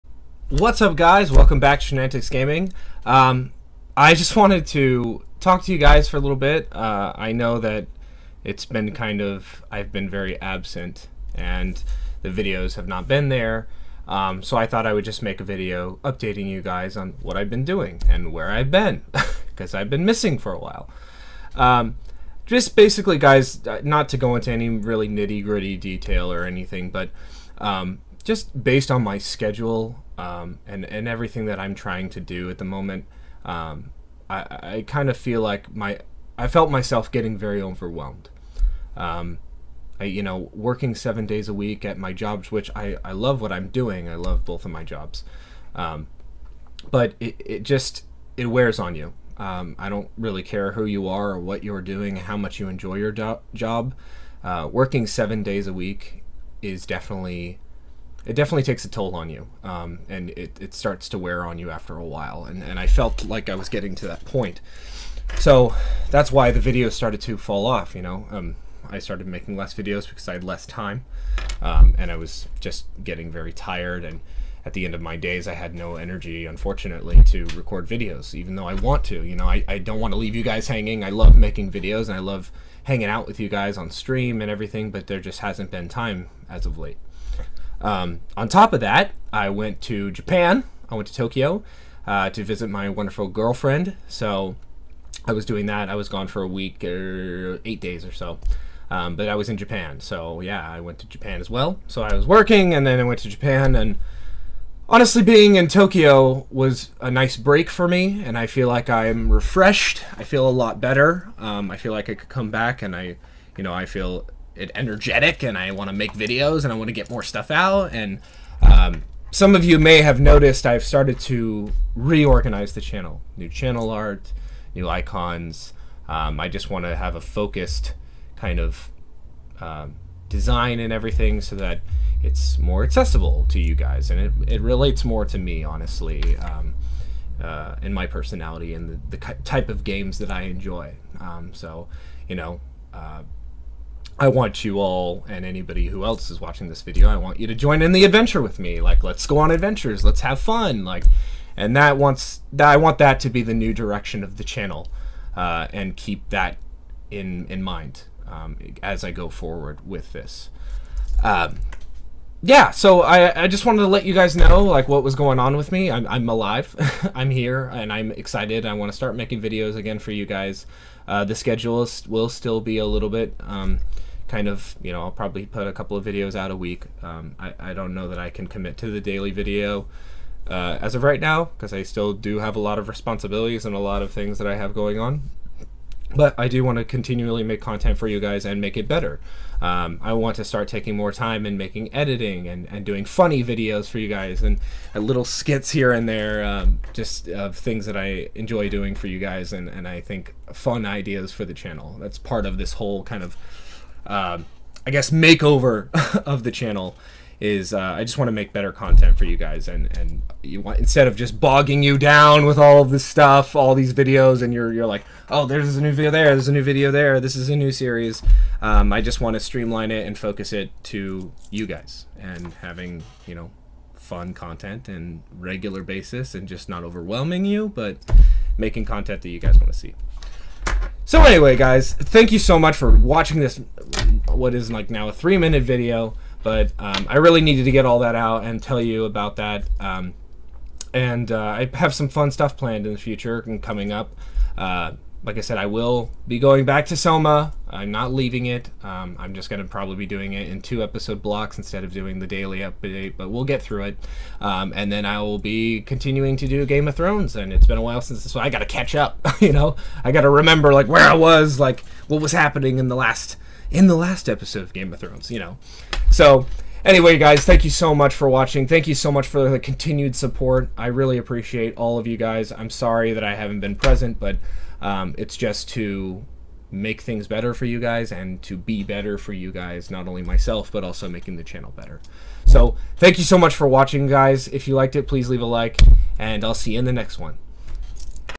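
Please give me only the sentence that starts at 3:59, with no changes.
Um, and uh, I have some fun stuff planned in the future and coming up.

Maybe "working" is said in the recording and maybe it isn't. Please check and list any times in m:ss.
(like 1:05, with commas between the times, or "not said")
0:40, 0:54, 1:42.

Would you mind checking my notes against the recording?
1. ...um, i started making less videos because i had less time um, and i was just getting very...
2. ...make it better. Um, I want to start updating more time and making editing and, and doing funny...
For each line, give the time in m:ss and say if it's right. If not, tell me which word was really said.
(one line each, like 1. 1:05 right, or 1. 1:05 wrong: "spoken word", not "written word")
1. 1:08 right
2. 3:08 wrong: "taking", not "updating".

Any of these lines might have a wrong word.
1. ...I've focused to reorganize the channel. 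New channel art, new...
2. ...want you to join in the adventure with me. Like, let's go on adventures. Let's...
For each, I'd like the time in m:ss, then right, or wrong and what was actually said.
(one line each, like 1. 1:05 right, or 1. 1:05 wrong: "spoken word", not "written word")
1. 2:00 wrong: "started", not "focused"
2. 2:27 right.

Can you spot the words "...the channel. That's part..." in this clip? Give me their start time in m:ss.
3:21.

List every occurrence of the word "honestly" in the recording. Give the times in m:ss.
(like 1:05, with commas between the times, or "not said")
1:44, 2:15.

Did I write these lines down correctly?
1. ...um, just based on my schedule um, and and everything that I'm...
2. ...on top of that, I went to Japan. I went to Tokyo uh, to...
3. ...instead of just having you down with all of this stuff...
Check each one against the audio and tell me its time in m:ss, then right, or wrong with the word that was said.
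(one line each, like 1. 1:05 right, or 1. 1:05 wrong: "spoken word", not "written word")
1. 0:27 right
2. 1:28 right
3. 3:30 wrong: "bogging", not "having".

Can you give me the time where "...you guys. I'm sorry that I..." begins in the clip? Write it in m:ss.
4:32.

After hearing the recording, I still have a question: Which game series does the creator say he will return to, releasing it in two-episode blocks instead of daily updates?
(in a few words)
Soma.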